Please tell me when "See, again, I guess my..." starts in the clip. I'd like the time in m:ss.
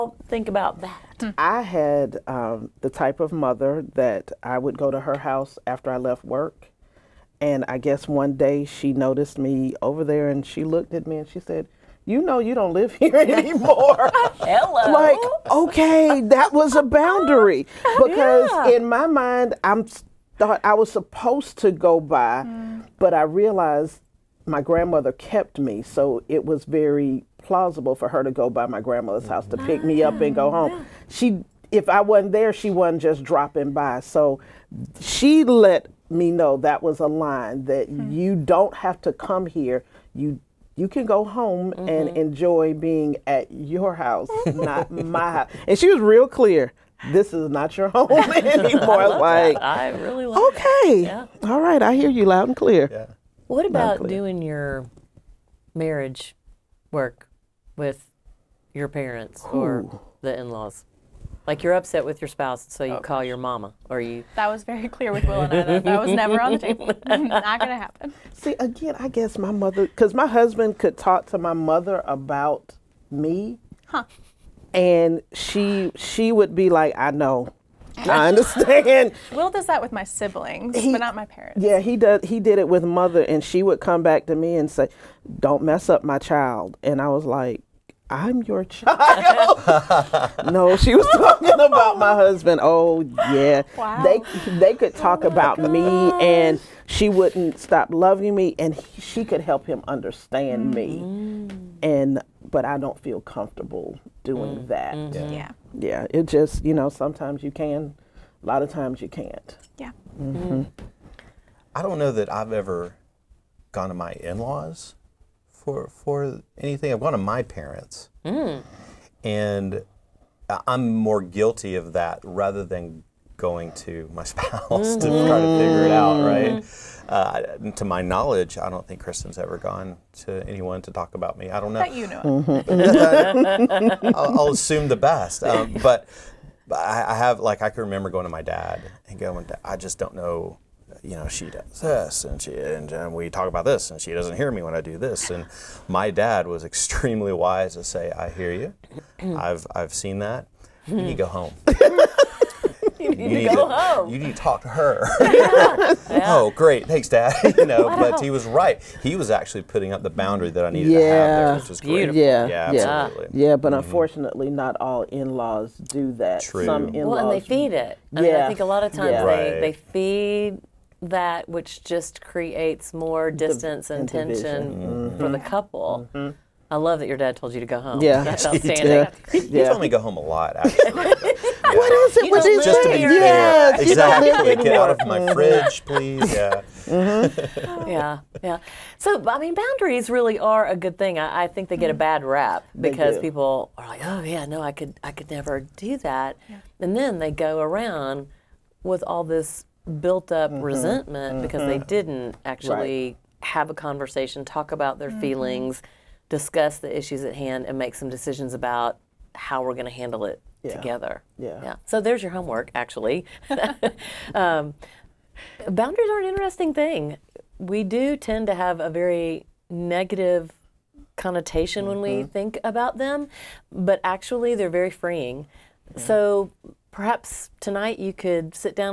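1:08.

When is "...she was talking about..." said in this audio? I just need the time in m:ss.
1:30.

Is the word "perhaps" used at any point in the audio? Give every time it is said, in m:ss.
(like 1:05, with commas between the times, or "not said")
3:46.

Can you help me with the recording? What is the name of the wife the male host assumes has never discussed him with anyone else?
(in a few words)
Kristen.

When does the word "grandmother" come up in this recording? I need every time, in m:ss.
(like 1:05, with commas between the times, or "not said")
0:24, 0:28.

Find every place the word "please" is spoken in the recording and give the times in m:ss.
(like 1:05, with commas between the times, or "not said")
3:05.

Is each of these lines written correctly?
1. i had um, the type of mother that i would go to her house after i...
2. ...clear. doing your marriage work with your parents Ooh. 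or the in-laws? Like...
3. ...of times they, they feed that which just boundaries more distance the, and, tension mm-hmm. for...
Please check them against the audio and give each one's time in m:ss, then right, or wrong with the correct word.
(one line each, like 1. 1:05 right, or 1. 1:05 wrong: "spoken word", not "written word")
1. 0:01 right
2. 0:53 right
3. 2:48 wrong: "creates", not "boundaries".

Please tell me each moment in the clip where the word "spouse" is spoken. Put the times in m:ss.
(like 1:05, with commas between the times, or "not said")
1:02, 2:04.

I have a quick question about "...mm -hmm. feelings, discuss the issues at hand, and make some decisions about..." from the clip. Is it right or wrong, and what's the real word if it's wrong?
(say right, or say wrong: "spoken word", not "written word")
right.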